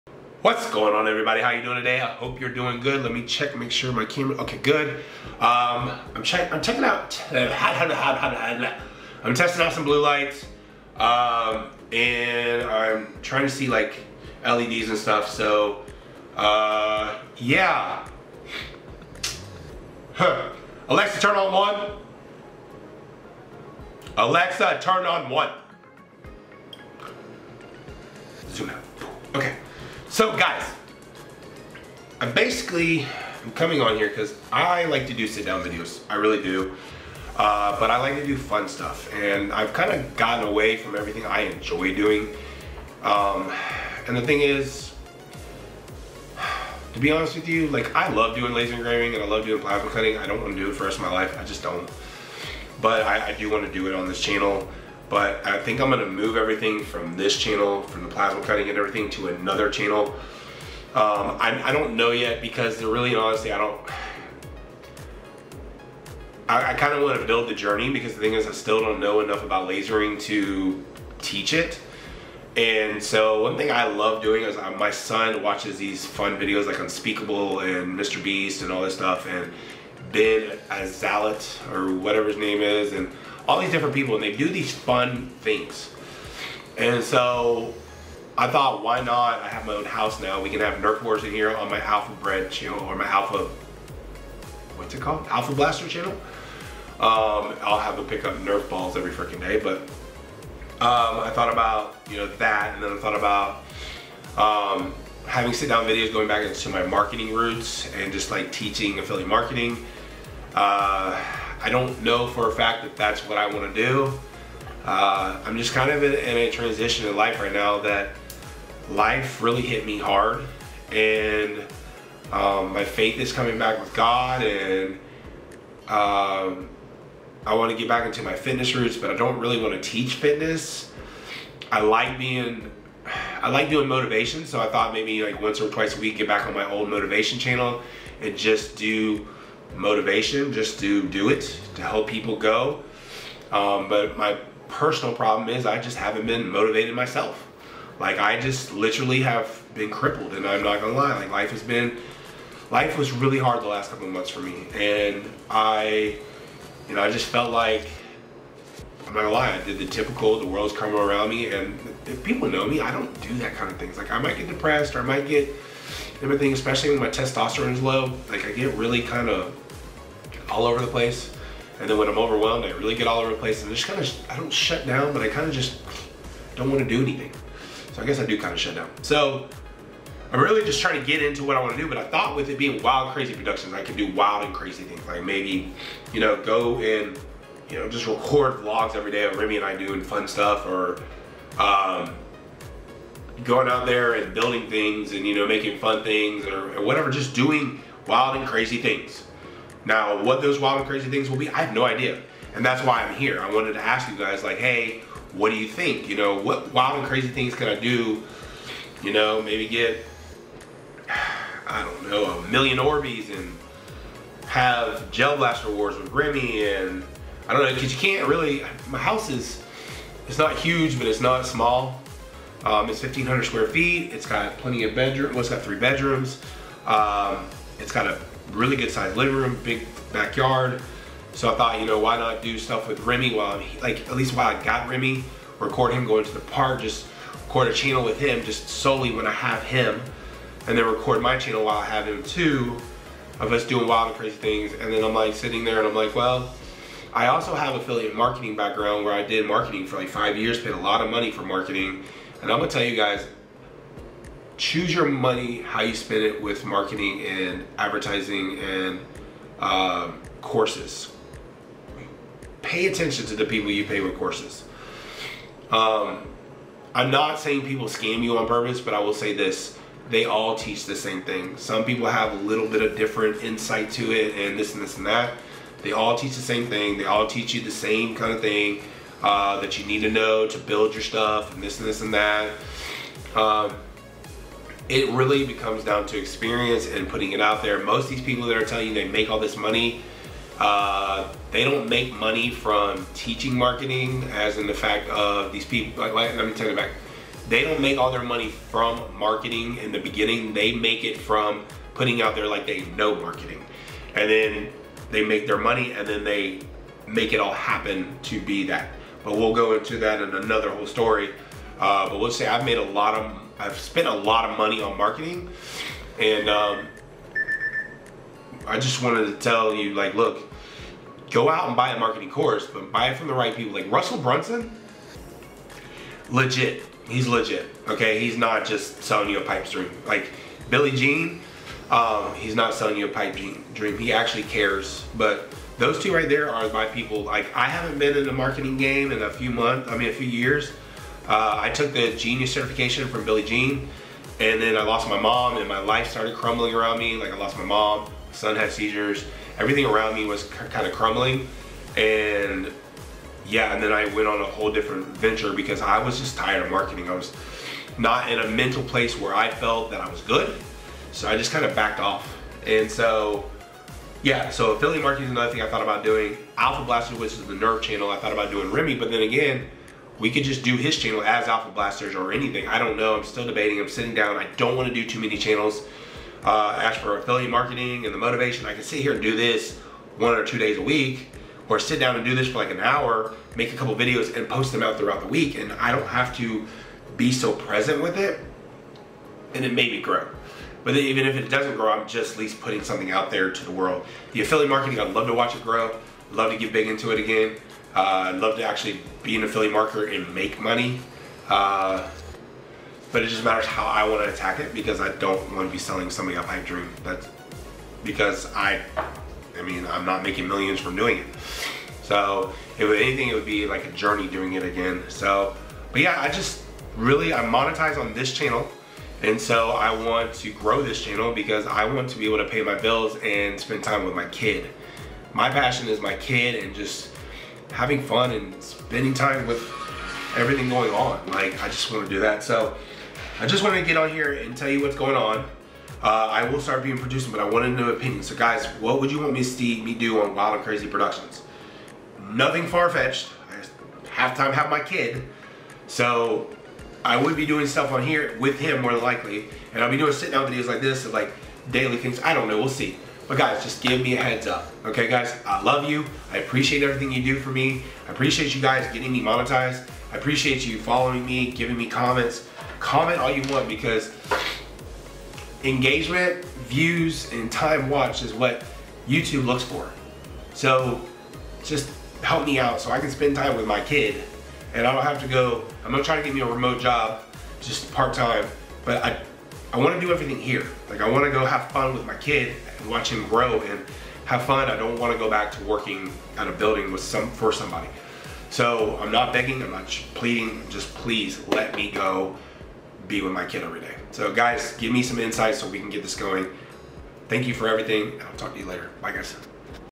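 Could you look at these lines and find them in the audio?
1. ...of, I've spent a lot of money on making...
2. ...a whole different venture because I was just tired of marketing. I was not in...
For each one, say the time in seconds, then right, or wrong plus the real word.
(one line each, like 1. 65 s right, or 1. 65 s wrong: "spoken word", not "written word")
1. 313 s wrong: "marketing", not "making"
2. 354 s right.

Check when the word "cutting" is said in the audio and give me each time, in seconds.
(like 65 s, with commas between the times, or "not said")
49 s, 58 s.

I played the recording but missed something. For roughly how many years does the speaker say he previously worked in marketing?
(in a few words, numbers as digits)
5.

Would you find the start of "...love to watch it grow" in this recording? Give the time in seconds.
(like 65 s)
395 s.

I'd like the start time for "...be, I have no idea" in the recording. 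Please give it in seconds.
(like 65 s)
201 s.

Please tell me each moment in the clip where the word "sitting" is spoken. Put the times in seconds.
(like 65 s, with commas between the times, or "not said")
245 s, 373 s.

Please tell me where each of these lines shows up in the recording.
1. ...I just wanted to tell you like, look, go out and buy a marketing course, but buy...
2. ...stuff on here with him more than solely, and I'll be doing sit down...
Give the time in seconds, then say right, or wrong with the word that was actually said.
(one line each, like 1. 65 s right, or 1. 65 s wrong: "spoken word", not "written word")
1. 318 s right
2. 447 s wrong: "likely", not "solely".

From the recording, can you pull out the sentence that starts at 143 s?
Um, but my personal problem is I just haven't been motivated myself.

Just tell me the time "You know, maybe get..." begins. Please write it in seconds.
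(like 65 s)
209 s.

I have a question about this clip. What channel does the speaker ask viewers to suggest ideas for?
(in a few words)
Wild and Crazy Productions.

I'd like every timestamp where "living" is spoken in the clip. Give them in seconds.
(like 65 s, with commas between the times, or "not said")
229 s.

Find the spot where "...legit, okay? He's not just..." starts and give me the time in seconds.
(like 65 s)
327 s.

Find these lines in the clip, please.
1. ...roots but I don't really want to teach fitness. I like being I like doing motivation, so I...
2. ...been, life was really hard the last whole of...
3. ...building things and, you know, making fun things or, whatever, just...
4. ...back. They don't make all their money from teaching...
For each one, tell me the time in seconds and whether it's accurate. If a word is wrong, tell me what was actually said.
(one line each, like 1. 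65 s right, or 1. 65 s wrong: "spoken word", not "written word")
1. 128 s right
2. 151 s wrong: "couple", not "whole"
3. 194 s right
4. 296 s wrong: "marketing", not "teaching".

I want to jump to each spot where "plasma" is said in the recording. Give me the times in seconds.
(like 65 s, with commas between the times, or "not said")
49 s, 58 s.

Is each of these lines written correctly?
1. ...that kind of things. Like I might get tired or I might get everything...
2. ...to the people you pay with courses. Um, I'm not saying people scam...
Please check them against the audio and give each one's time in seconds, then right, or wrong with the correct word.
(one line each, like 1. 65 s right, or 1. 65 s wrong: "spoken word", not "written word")
1. 163 s wrong: "depressed", not "tired"
2. 263 s right.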